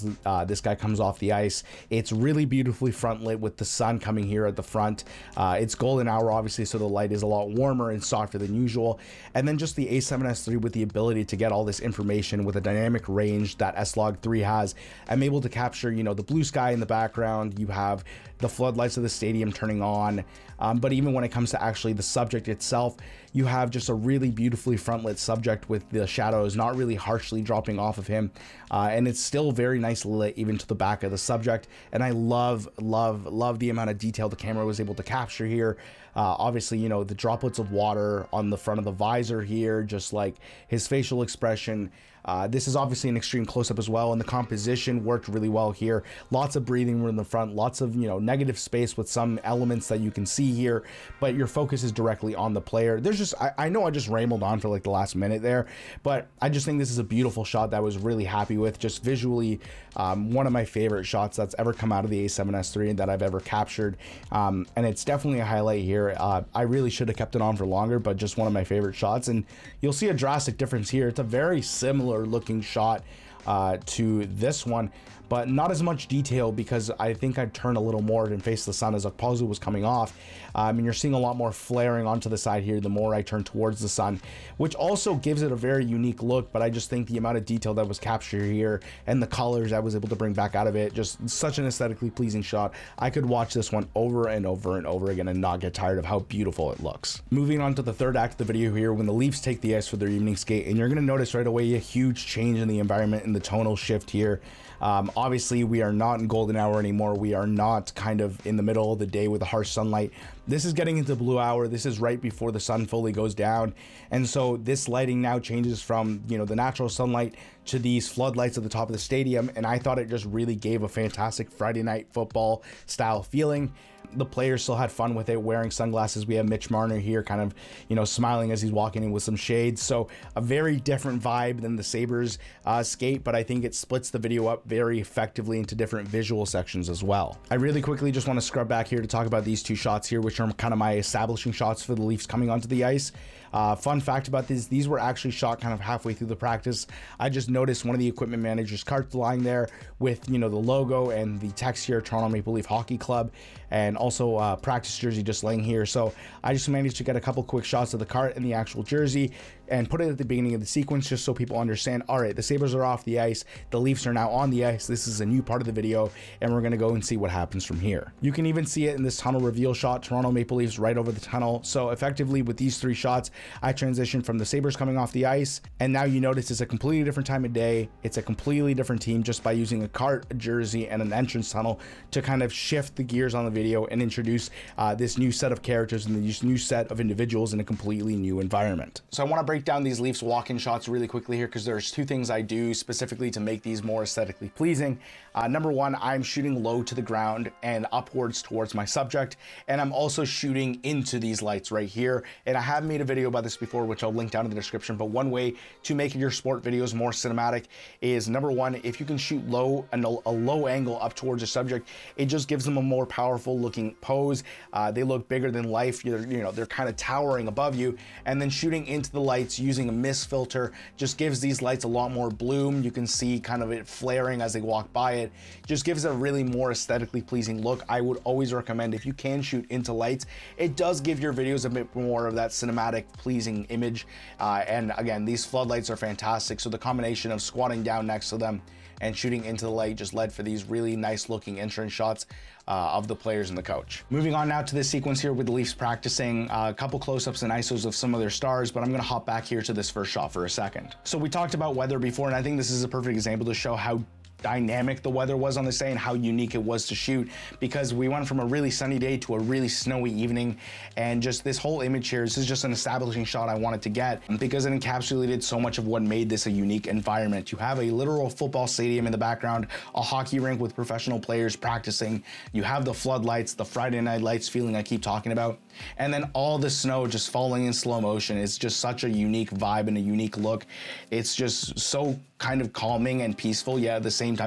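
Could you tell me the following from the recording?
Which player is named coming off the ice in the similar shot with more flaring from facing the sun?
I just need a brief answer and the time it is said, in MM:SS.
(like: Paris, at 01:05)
Okposo, at 01:19.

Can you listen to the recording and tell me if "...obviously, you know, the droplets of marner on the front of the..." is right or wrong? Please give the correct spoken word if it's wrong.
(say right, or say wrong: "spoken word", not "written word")
wrong: "water", not "marner".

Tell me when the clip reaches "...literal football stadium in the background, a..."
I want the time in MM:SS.
04:27.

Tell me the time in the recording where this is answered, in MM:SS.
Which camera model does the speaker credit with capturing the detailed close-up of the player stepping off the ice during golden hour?
00:09.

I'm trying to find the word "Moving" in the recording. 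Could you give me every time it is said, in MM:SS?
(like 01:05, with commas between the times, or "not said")
01:37, 04:04.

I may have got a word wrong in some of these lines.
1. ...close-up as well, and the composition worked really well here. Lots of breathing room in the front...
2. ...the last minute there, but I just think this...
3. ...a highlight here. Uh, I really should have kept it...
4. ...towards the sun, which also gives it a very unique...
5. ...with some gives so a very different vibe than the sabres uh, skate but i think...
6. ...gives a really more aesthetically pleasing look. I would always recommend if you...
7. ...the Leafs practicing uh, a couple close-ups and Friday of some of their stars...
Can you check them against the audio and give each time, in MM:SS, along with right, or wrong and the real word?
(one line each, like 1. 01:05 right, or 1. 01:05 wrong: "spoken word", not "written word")
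1. 00:43 right
2. 00:54 right
3. 01:05 right
4. 01:23 right
5. 02:09 wrong: "shades", not "gives"
6. 03:45 right
7. 04:05 wrong: "ISOs", not "Friday".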